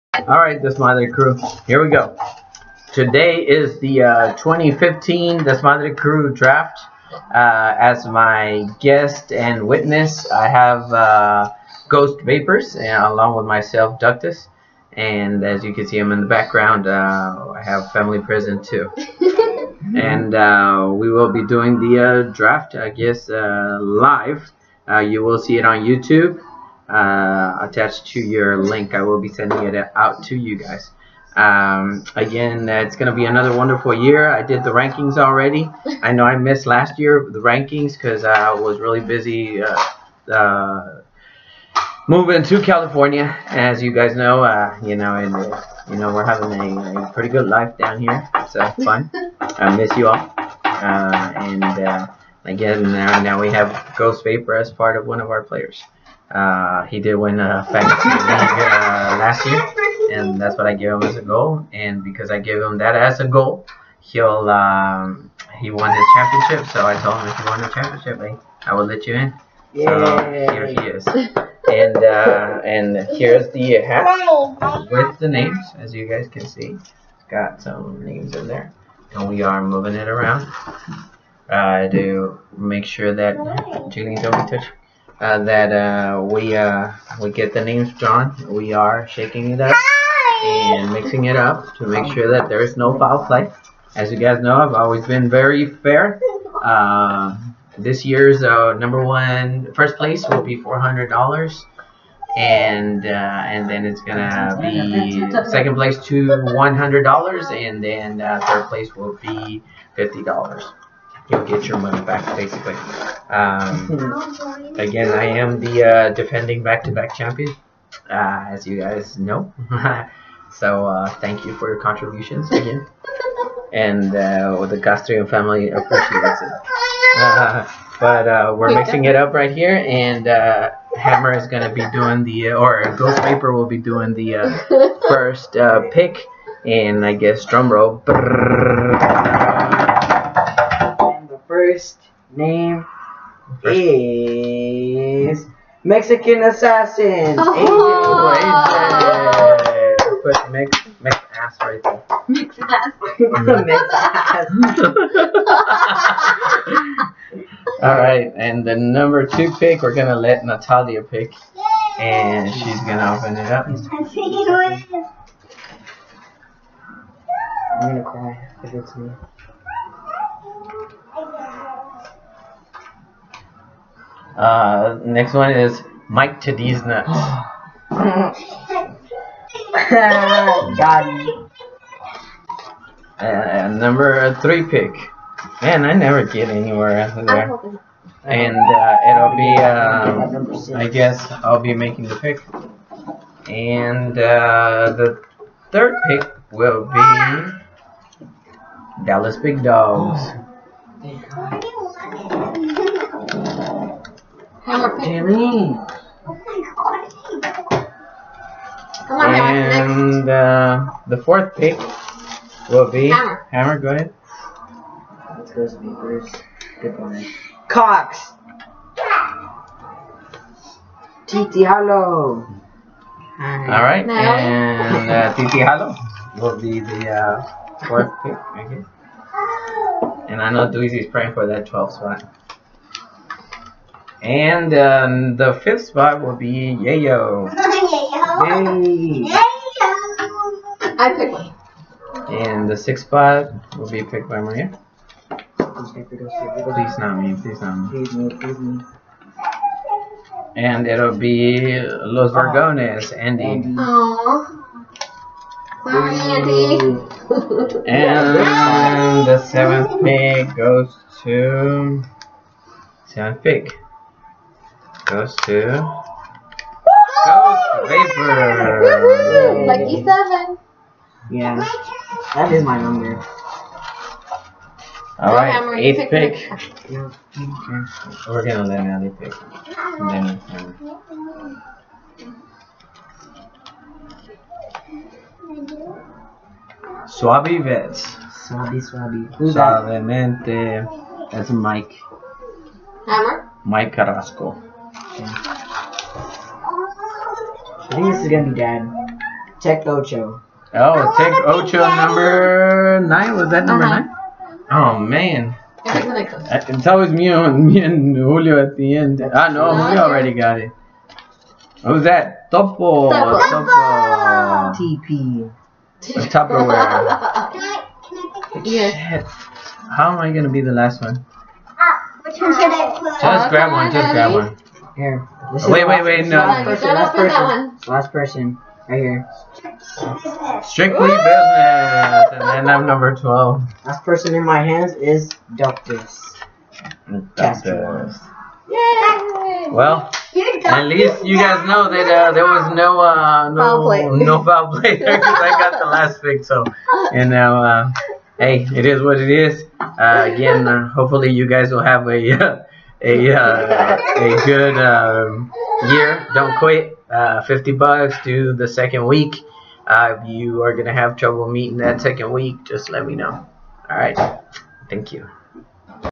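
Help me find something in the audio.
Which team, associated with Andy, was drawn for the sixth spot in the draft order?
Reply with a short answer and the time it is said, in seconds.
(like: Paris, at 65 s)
Los Vergones, at 251 s.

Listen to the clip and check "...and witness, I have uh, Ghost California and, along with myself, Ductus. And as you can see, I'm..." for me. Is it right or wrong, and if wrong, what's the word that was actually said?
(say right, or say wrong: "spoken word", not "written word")
wrong: "Vapors", not "California".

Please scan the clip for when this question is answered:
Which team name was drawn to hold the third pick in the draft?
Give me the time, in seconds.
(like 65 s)
199 s.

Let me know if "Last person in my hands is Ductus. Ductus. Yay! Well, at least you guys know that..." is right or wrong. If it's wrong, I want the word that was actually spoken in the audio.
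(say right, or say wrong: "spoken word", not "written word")
right.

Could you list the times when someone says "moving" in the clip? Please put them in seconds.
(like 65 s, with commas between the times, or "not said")
42 s, 79 s.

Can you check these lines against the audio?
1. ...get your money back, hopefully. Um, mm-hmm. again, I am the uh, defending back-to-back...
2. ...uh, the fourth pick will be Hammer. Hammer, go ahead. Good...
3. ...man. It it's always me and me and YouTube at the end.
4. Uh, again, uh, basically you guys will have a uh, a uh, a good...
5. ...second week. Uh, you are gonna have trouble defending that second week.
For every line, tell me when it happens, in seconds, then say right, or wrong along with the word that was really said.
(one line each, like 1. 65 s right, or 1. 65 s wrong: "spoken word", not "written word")
1. 111 s wrong: "basically", not "hopefully"
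2. 210 s right
3. 305 s wrong: "Julio", not "YouTube"
4. 349 s wrong: "hopefully", not "basically"
5. 358 s wrong: "meeting", not "defending".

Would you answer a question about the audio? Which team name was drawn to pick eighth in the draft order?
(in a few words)
Suave Vets.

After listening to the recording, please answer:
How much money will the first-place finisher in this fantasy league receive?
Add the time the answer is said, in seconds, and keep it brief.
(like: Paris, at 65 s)
$400, at 100 s.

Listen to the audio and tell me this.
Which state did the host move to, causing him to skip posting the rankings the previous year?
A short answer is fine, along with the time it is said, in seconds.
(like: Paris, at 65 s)
California, at 42 s.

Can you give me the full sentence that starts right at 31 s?
Um, again, it's going to be another wonderful year.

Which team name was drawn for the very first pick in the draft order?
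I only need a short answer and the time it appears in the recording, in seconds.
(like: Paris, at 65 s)
Mexican Assassin, at 145 s.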